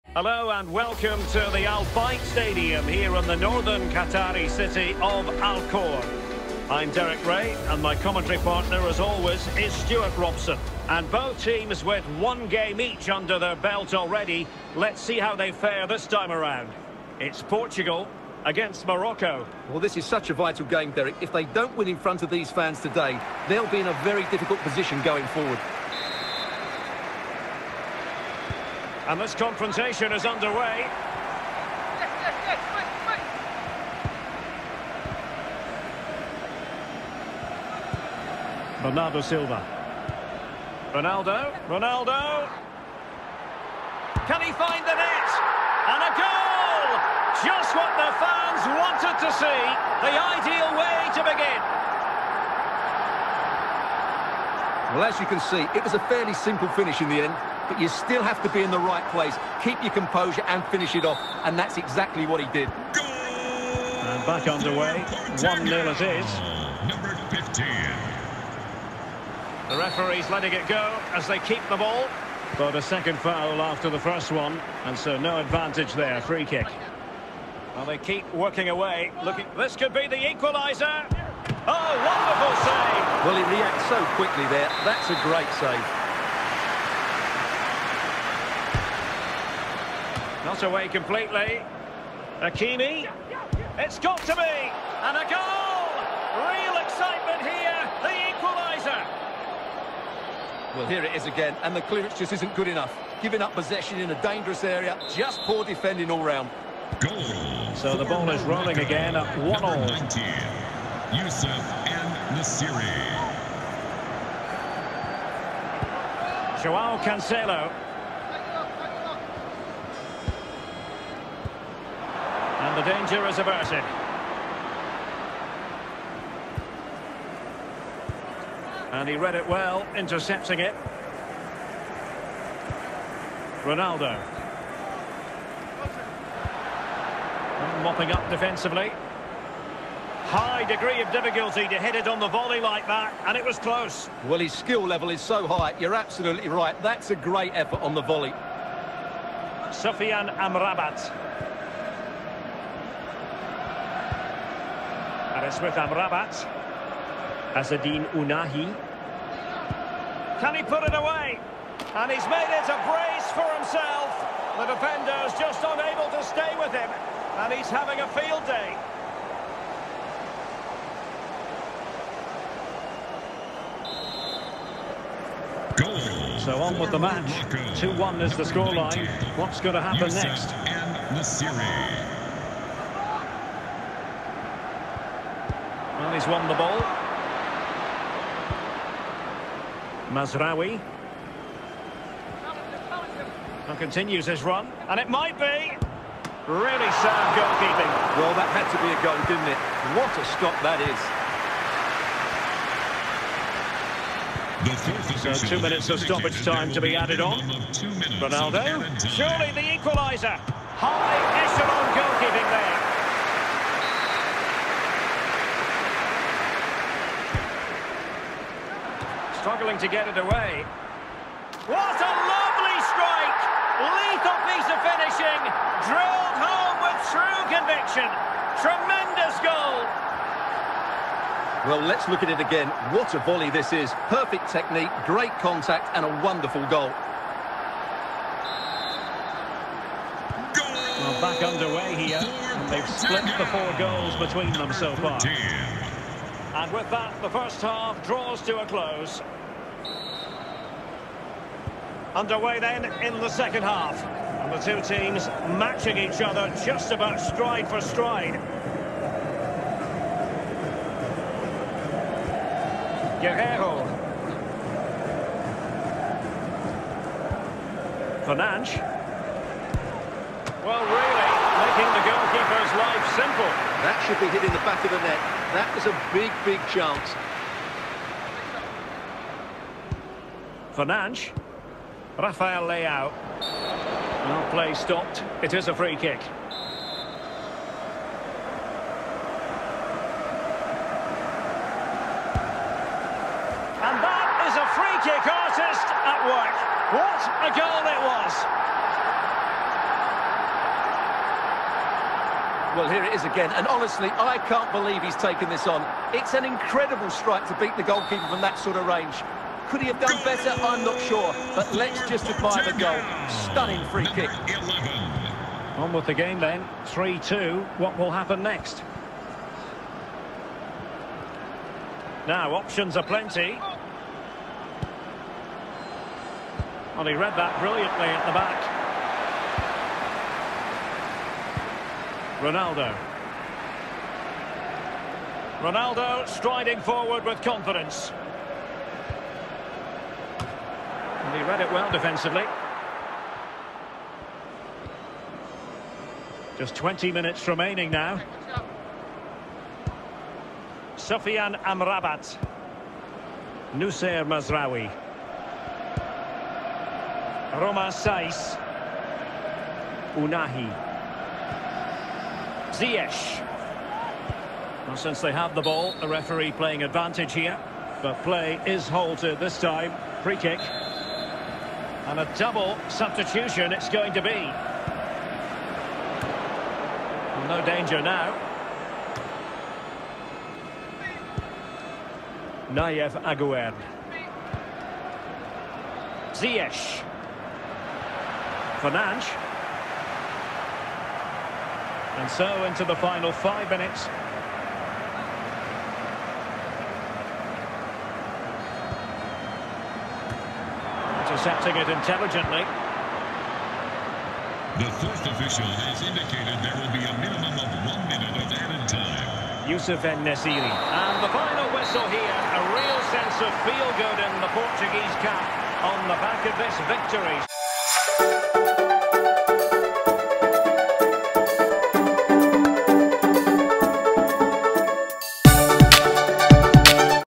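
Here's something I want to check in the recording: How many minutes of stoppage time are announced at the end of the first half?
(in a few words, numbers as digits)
2.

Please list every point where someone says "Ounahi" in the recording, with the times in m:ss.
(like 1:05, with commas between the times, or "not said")
2:38, 6:00.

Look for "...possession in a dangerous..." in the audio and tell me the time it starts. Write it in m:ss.
1:43.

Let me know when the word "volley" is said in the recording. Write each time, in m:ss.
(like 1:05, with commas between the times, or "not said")
2:22, 2:28, 3:53.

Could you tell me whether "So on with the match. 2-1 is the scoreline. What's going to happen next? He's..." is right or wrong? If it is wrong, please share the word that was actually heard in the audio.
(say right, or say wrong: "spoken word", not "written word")
right.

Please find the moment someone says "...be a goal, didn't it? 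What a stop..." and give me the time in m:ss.
3:18.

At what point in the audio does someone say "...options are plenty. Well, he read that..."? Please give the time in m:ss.
5:22.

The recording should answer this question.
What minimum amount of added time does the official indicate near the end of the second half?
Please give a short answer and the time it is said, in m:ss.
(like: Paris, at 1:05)
1 minute, at 6:47.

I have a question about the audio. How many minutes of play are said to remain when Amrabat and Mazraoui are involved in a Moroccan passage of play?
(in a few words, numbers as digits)
20.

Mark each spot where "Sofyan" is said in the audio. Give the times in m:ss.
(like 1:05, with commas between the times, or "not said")
2:29, 5:50.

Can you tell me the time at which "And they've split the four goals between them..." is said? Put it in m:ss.
4:02.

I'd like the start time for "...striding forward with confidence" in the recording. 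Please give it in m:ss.
5:36.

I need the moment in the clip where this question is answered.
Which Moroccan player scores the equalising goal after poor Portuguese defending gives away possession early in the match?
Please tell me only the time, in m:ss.
1:32.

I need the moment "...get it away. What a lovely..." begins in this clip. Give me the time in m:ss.
3:39.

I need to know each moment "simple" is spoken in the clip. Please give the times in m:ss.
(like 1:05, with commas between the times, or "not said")
0:56, 4:33.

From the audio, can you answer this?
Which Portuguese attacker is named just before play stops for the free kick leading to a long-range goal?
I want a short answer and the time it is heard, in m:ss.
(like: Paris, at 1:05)
Rafael Leao, at 4:42.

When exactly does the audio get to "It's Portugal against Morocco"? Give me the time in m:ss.
0:17.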